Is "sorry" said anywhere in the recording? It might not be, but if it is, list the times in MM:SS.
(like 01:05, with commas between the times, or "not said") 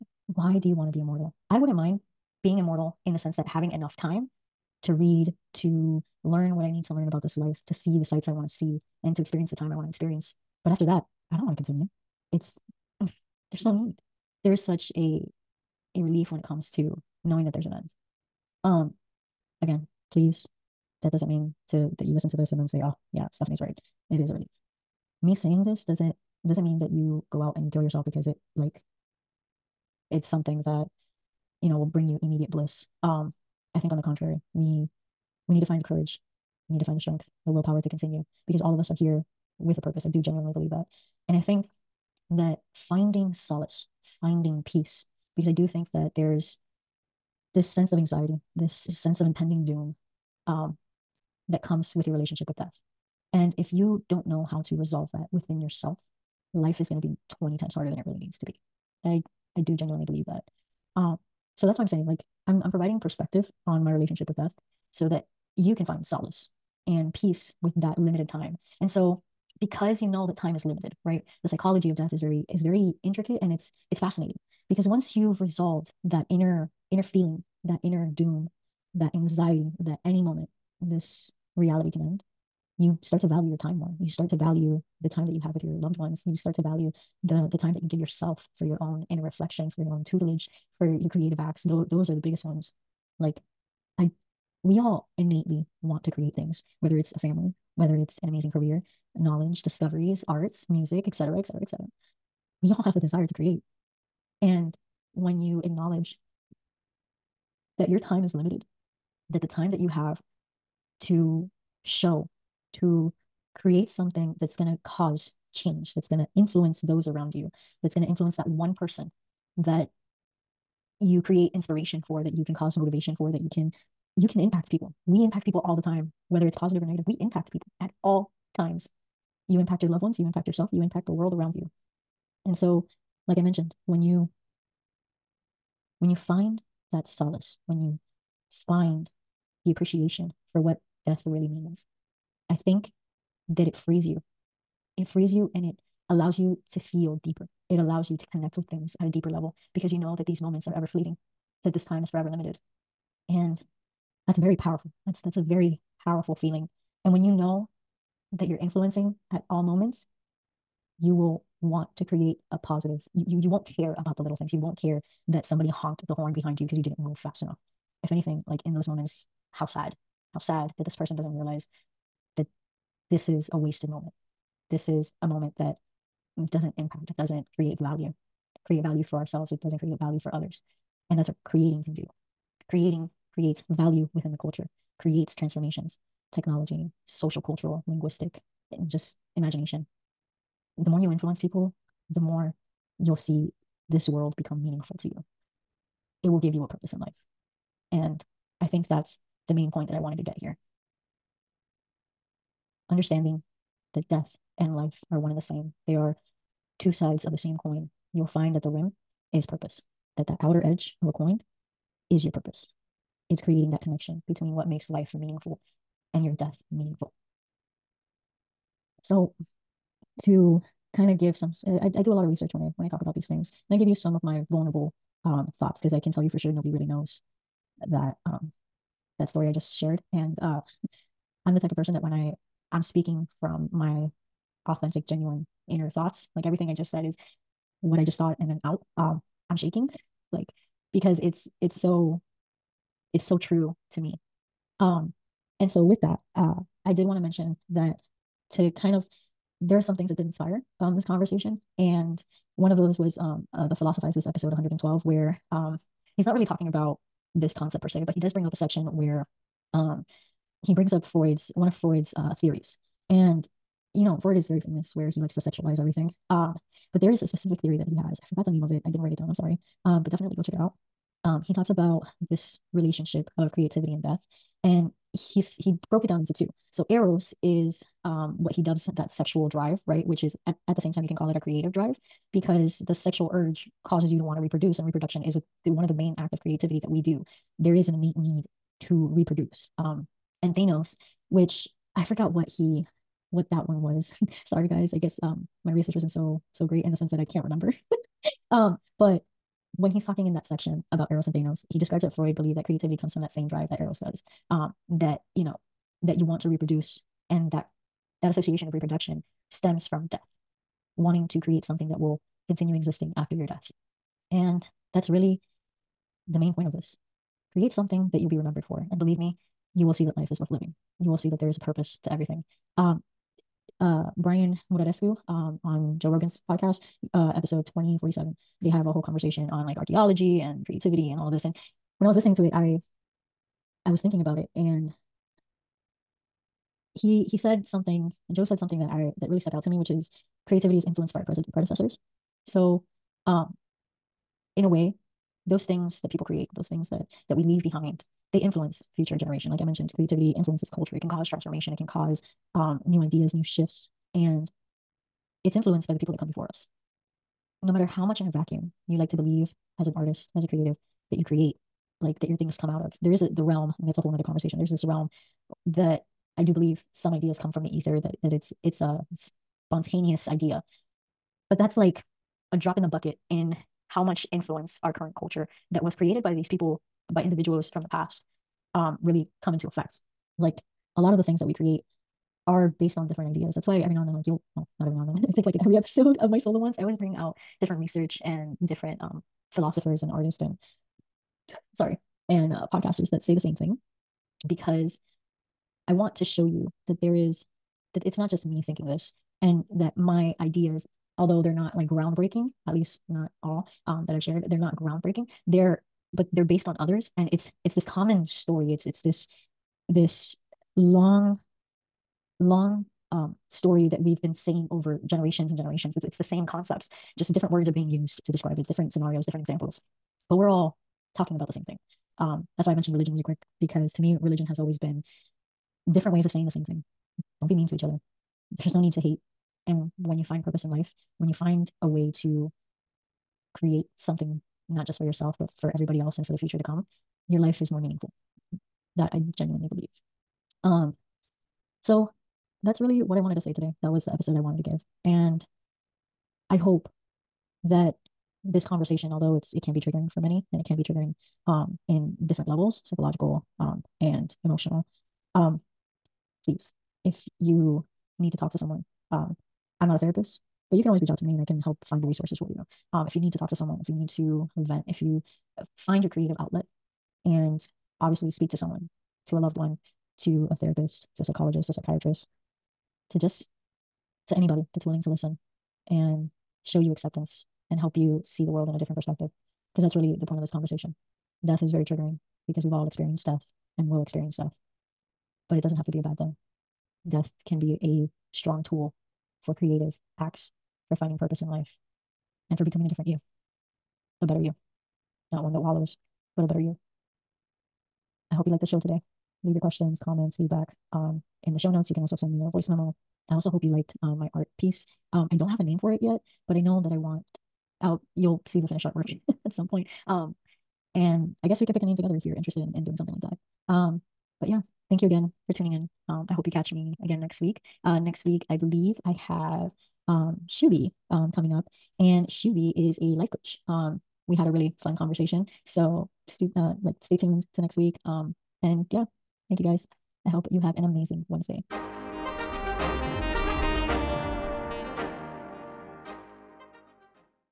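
04:29, 04:54, 06:31.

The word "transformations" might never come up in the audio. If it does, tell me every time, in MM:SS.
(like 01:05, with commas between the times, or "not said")
03:05, 05:51.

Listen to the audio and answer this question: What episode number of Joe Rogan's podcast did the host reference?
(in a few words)
2047.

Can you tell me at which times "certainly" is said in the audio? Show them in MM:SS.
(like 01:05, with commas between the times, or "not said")
not said.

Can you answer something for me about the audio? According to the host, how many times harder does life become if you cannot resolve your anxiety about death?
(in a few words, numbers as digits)
20.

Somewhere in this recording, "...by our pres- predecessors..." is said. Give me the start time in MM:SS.
05:41.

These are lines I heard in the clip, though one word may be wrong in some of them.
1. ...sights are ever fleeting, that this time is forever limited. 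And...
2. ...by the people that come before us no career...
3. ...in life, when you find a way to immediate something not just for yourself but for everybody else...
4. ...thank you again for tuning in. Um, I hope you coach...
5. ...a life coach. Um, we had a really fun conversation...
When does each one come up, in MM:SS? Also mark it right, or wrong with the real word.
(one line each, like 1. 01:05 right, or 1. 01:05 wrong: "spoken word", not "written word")
1. 02:30 wrong: "moments", not "sights"
2. 05:55 wrong: "matter", not "career"
3. 07:10 wrong: "create", not "immediate"
4. 08:34 wrong: "catch", not "coach"
5. 08:43 right.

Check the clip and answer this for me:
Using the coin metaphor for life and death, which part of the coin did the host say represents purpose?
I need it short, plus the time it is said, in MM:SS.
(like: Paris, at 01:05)
The rim, at 03:28.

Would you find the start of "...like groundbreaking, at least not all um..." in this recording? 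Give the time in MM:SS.
06:41.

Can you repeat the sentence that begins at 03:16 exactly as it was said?
It will give you a purpose in life.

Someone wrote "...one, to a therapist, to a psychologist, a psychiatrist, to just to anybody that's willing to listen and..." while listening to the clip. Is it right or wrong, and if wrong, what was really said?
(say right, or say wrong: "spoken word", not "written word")
right.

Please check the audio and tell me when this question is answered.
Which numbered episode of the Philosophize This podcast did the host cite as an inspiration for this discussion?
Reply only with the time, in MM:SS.
04:14.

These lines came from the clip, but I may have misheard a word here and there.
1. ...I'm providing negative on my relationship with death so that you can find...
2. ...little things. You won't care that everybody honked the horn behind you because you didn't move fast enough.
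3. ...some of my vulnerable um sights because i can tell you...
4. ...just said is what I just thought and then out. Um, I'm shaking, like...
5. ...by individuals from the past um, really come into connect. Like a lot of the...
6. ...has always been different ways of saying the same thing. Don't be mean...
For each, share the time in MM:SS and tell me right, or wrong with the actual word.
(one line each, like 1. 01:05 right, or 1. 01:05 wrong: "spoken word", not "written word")
1. 01:02 wrong: "perspective", not "negative"
2. 02:44 wrong: "somebody", not "everybody"
3. 03:43 wrong: "thoughts", not "sights"
4. 03:56 right
5. 06:17 wrong: "effect", not "connect"
6. 07:04 right.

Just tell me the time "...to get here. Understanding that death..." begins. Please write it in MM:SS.
03:20.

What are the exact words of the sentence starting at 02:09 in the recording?
You impact your loved ones, you impact yourself, you impact the world around you.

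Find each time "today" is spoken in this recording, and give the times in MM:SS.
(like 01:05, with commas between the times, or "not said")
07:23, 08:18.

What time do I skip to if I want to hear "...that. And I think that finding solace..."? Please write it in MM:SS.
00:40.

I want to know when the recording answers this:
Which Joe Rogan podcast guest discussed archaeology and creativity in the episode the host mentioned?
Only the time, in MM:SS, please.
05:24.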